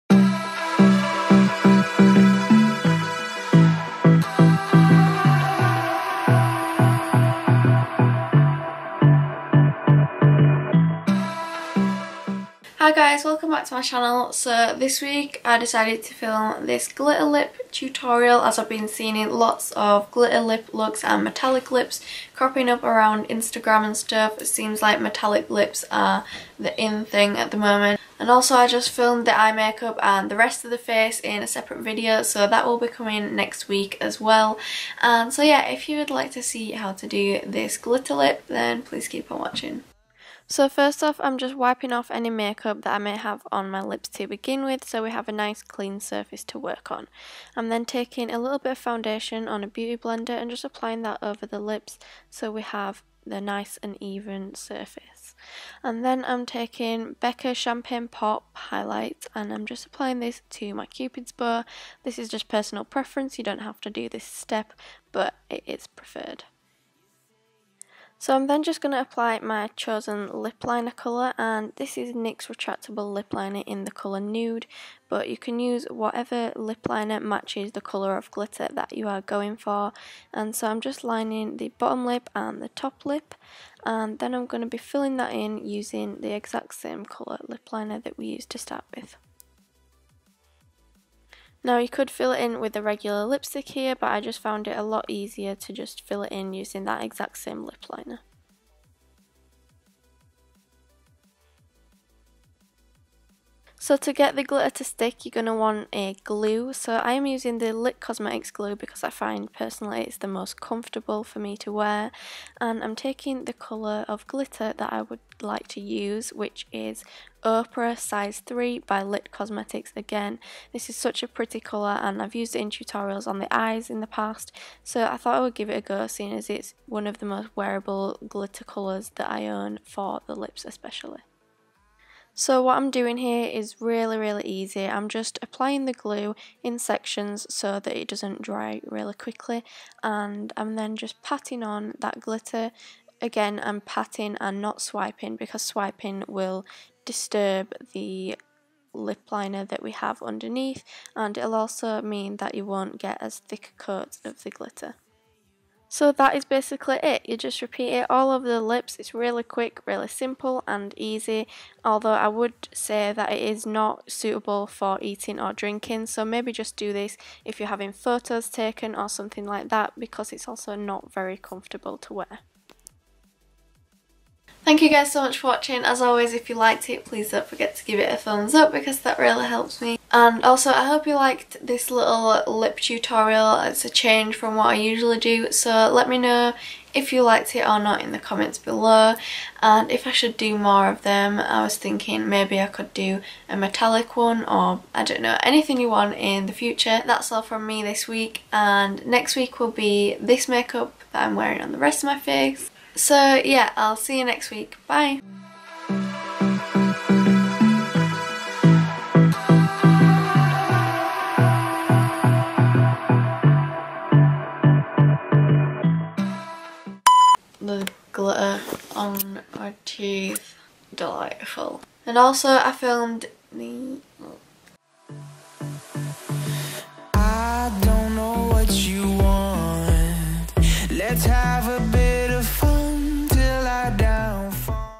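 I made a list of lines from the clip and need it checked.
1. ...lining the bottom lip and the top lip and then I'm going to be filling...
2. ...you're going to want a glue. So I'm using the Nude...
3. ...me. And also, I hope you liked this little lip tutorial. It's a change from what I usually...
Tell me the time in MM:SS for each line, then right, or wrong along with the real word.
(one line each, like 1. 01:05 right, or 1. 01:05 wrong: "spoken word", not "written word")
1. 01:21 right
2. 01:45 wrong: "Lit", not "Nude"
3. 02:59 right.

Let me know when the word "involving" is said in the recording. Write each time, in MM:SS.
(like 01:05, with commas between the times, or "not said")
not said.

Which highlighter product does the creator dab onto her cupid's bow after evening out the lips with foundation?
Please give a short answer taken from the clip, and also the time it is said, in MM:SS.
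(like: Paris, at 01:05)
Becca Champagne Pop, at 00:57.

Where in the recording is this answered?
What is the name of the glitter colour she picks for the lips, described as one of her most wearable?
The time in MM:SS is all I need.
01:57.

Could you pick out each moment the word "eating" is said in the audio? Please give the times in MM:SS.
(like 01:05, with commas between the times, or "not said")
02:45.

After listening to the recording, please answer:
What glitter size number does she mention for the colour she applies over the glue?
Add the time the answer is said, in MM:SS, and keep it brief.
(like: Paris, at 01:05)
3, at 01:57.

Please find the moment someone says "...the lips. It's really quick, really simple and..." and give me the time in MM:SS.
02:38.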